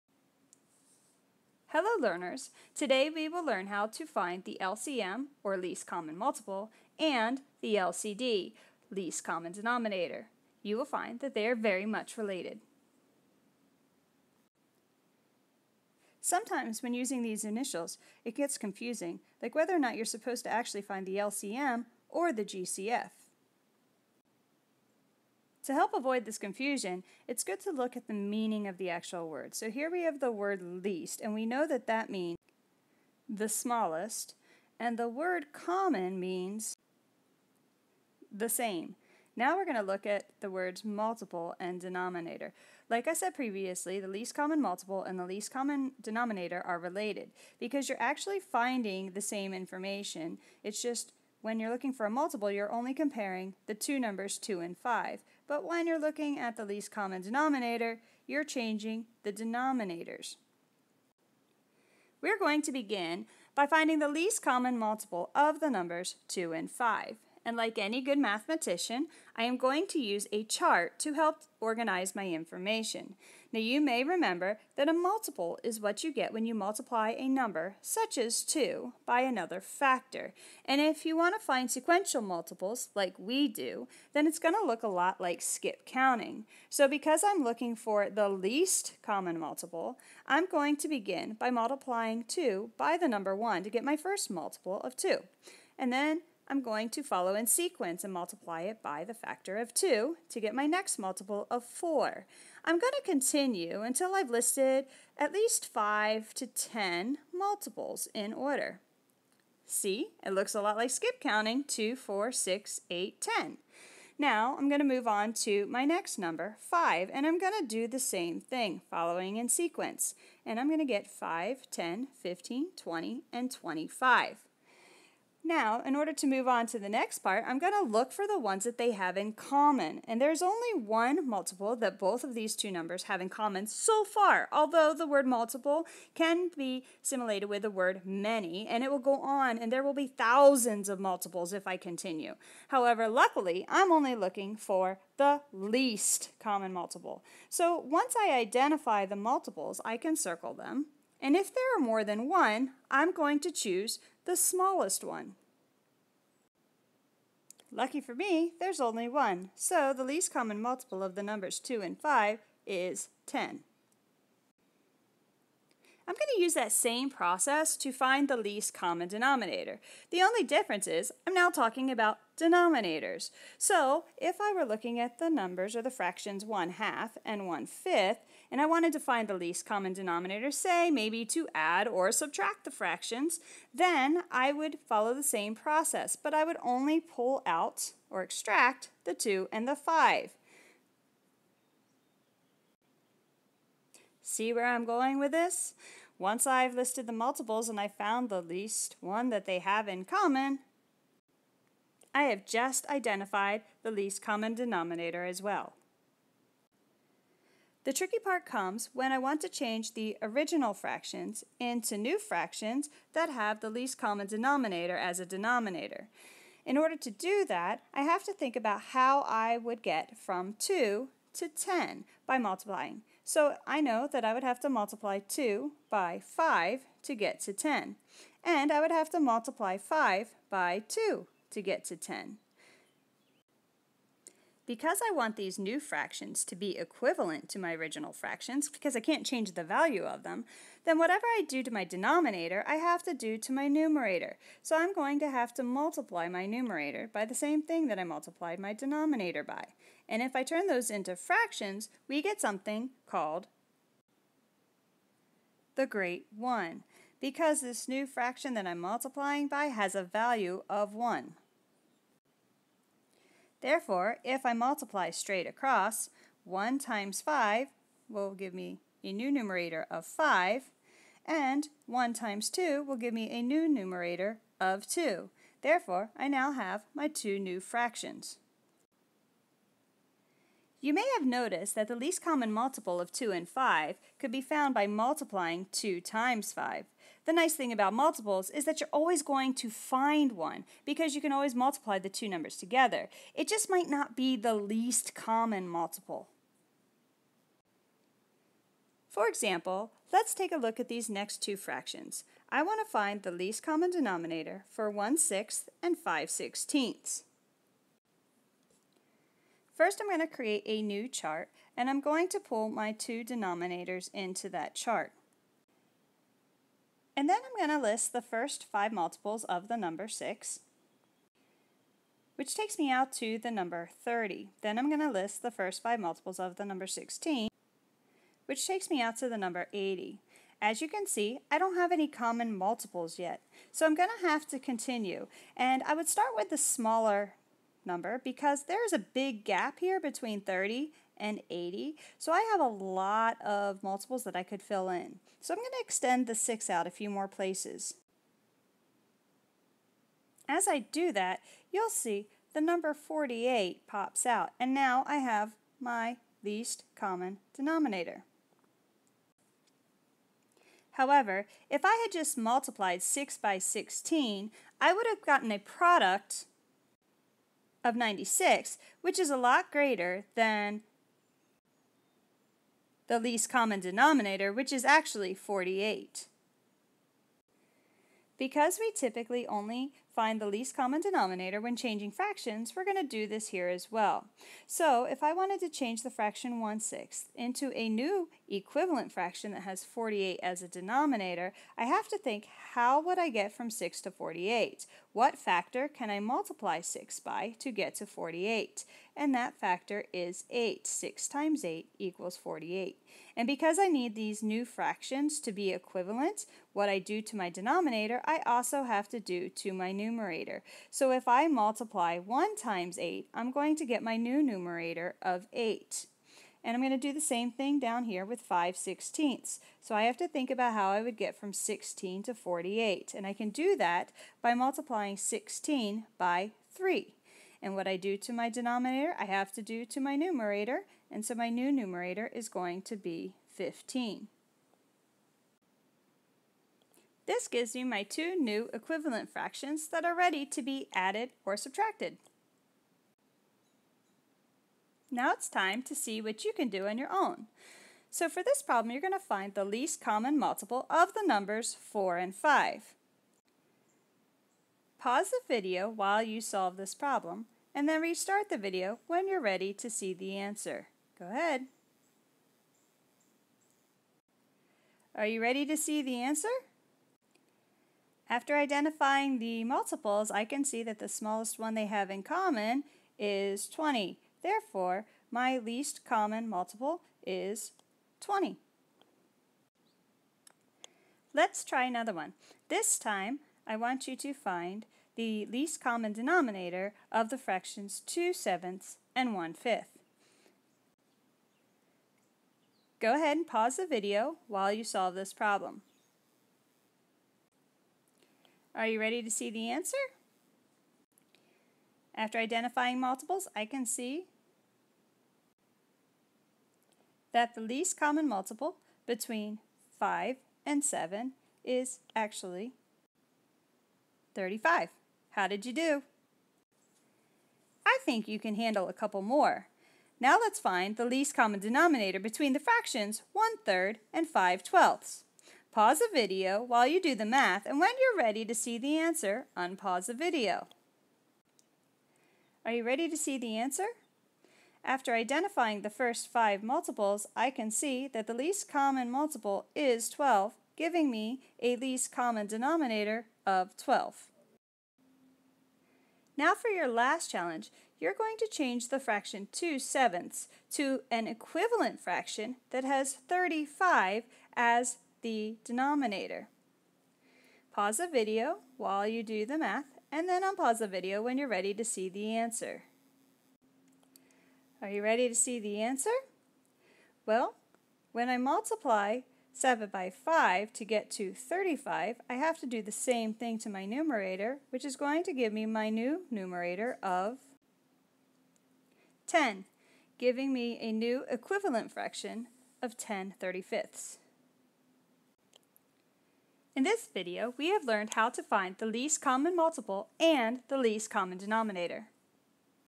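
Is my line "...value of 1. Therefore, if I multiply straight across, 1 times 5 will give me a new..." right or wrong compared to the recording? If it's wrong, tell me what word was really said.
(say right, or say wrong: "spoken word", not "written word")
right.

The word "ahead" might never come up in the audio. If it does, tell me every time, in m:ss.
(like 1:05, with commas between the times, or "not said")
7:41, 8:13.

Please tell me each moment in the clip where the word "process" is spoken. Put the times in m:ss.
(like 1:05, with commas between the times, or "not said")
2:47, 3:05.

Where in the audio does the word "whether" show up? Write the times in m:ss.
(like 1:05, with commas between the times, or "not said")
0:19.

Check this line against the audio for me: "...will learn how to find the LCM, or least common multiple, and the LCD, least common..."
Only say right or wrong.
right.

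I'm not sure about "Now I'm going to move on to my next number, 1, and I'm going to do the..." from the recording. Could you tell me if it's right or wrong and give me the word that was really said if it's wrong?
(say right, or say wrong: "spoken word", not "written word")
wrong: "5", not "1".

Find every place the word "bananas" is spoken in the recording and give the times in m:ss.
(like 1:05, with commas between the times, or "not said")
not said.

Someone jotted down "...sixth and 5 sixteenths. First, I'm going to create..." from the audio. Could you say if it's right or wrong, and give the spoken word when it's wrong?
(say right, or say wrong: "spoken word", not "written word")
right.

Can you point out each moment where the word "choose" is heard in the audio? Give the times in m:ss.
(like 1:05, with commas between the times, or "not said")
2:33.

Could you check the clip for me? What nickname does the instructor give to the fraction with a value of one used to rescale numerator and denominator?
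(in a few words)
the great 1.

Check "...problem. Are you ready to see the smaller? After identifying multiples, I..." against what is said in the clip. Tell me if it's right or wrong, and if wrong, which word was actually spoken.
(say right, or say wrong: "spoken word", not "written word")
wrong: "answer", not "smaller".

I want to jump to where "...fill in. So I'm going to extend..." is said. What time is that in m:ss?
5:44.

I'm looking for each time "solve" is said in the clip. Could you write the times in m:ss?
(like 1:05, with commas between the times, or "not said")
7:36, 8:14.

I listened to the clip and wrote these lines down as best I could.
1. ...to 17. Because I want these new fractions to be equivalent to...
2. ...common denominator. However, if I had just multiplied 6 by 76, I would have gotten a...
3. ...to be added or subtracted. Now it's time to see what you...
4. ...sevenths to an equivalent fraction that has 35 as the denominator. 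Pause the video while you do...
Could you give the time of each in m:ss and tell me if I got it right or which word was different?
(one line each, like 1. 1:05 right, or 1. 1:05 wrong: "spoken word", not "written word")
1. 3:51 wrong: "10", not "17"
2. 5:56 wrong: "16", not "76"
3. 7:20 right
4. 9:09 right.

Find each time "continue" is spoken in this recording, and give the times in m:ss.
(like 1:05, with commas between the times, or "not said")
1:43, 2:21, 5:34.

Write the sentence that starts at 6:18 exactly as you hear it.
Because we typically only find the least common denominator when changing fractions, we're going to do this here as well.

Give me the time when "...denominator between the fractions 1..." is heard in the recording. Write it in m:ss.
8:41.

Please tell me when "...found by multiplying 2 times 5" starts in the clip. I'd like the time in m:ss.
4:44.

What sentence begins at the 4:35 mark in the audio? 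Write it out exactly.
Therefore, I now have my two new fractions.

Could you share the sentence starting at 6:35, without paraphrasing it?
What factor can I multiply 6 by to get to 48?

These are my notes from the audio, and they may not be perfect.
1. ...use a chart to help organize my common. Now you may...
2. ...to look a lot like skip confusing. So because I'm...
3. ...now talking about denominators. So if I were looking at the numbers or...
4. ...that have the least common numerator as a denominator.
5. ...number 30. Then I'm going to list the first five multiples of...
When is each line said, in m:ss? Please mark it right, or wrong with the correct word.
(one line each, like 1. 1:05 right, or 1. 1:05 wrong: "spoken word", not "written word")
1. 1:09 wrong: "information", not "common"
2. 1:24 wrong: "counting", not "confusing"
3. 2:51 right
4. 3:33 wrong: "denominator", not "numerator"
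5. 5:23 right.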